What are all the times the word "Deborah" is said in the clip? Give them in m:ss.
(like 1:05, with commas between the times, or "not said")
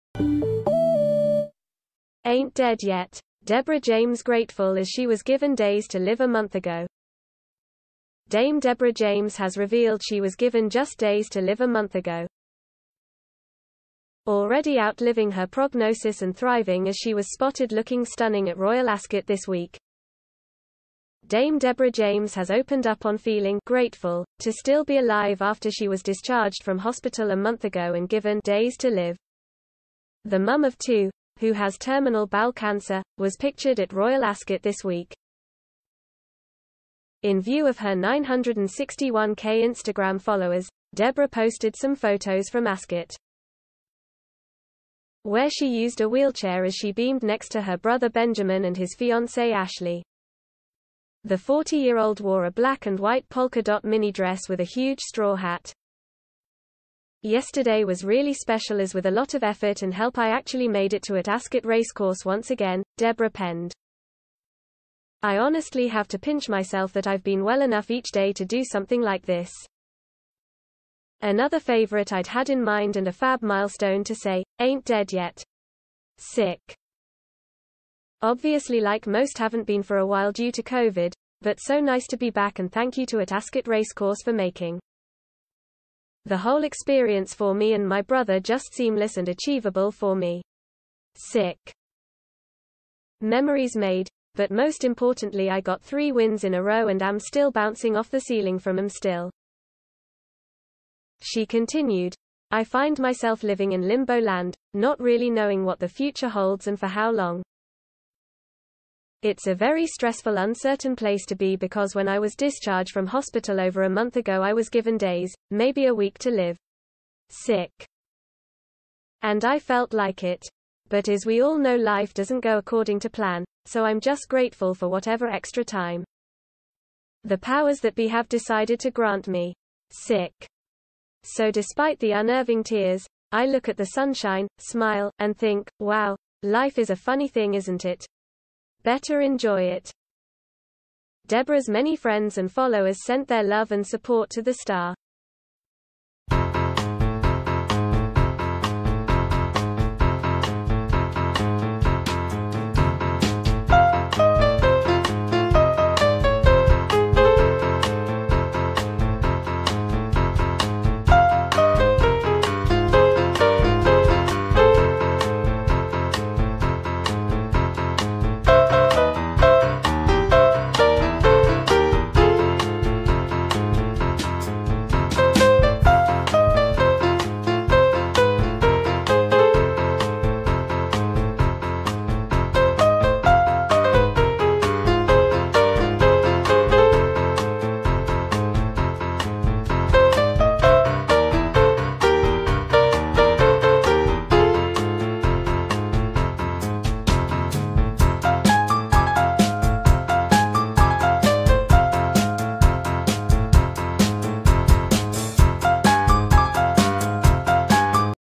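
0:03, 0:08, 0:21, 0:40, 1:02, 2:21.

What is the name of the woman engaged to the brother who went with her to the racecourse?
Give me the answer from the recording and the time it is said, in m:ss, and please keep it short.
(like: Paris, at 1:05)
Ashley, at 0:49.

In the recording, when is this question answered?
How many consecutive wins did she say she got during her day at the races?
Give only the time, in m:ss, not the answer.
1:35.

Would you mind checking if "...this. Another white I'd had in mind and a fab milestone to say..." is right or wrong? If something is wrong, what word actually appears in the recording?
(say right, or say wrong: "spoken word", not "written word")
wrong: "favorite", not "white".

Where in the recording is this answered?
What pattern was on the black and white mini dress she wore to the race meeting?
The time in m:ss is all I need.
0:53.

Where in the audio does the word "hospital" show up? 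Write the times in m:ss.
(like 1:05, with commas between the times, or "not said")
0:26, 1:53.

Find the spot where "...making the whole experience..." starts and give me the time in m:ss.
1:24.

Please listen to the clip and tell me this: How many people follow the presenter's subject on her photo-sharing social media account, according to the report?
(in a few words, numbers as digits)
961k.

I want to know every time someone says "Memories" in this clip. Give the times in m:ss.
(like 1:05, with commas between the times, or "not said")
1:33.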